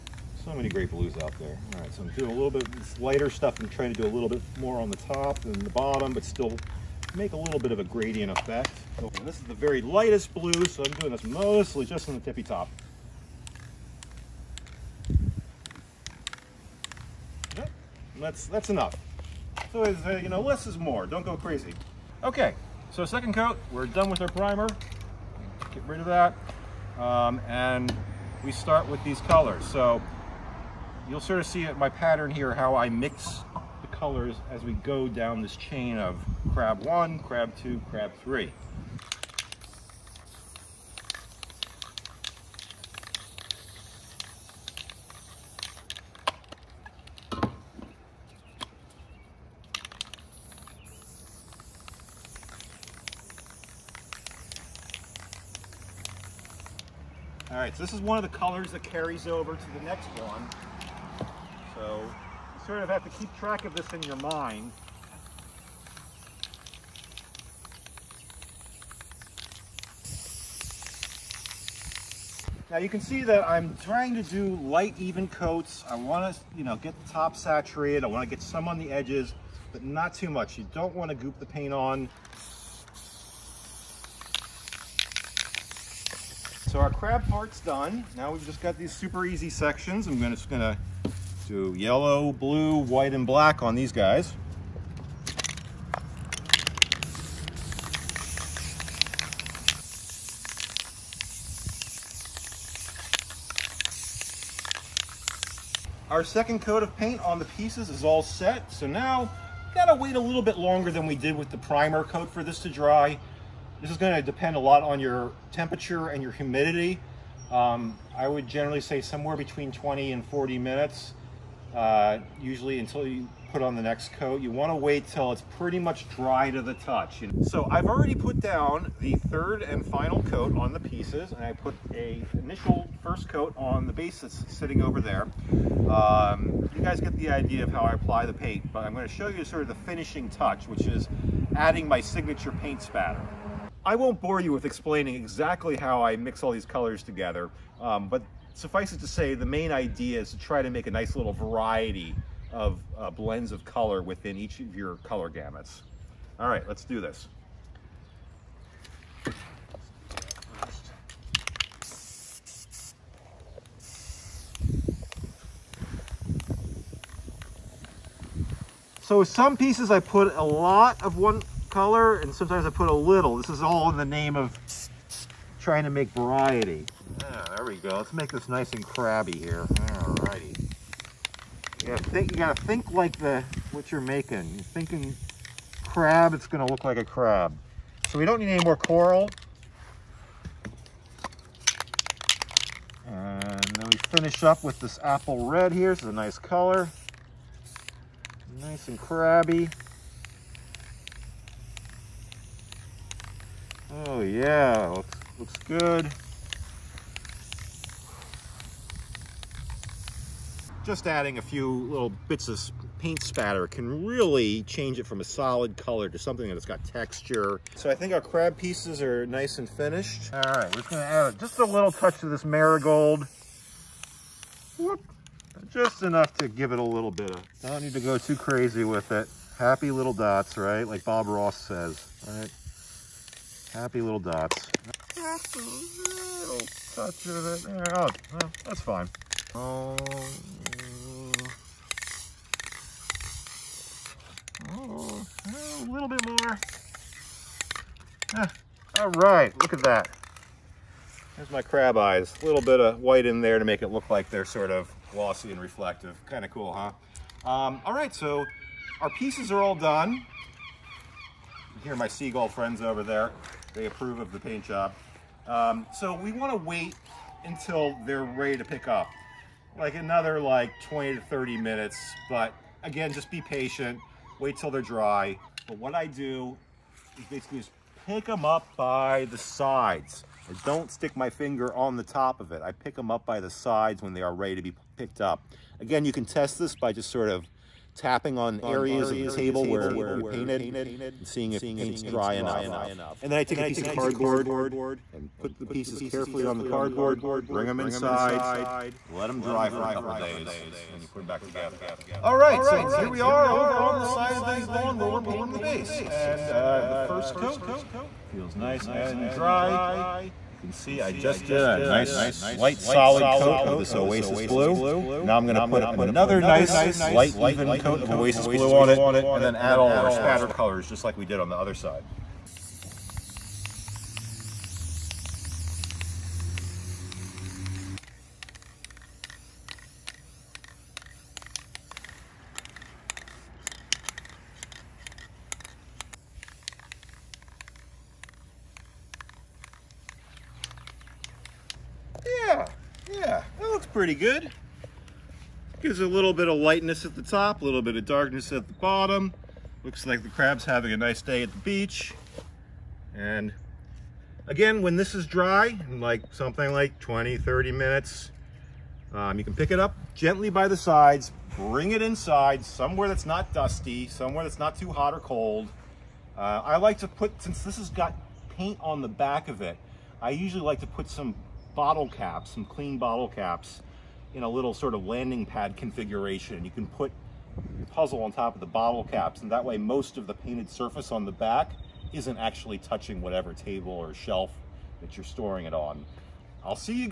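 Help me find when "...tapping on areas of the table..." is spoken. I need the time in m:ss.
4:47.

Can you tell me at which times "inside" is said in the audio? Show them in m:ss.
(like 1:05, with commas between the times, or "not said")
4:57, 6:02.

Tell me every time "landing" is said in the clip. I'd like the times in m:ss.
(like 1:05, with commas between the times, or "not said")
6:15.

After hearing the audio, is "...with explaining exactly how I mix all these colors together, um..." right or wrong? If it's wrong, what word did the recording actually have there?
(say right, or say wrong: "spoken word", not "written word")
right.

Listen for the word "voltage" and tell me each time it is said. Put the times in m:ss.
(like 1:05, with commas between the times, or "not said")
not said.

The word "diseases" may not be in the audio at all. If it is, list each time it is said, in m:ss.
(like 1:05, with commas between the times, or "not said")
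not said.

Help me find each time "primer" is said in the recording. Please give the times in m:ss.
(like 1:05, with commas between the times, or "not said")
0:24, 1:51.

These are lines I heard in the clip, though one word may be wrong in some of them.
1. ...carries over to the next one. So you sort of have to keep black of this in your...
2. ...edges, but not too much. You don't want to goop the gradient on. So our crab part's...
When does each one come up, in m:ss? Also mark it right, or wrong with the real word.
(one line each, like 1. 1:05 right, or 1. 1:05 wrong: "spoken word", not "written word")
1. 0:58 wrong: "track", not "black"
2. 1:18 wrong: "paint", not "gradient".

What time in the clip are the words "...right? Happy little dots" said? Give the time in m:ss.
3:52.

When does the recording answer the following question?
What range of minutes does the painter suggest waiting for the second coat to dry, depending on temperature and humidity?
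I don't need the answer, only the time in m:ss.
1:59.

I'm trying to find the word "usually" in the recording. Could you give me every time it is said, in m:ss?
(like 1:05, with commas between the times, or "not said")
2:02, 6:10.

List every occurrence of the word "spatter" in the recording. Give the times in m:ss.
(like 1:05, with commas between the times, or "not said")
2:22, 3:33, 5:20.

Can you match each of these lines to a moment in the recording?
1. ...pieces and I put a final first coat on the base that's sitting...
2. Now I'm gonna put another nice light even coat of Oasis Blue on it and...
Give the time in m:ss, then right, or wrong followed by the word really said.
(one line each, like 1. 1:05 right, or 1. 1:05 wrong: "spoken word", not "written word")
1. 2:10 wrong: "initial", not "final"
2. 5:15 right.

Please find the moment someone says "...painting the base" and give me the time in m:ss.
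5:05.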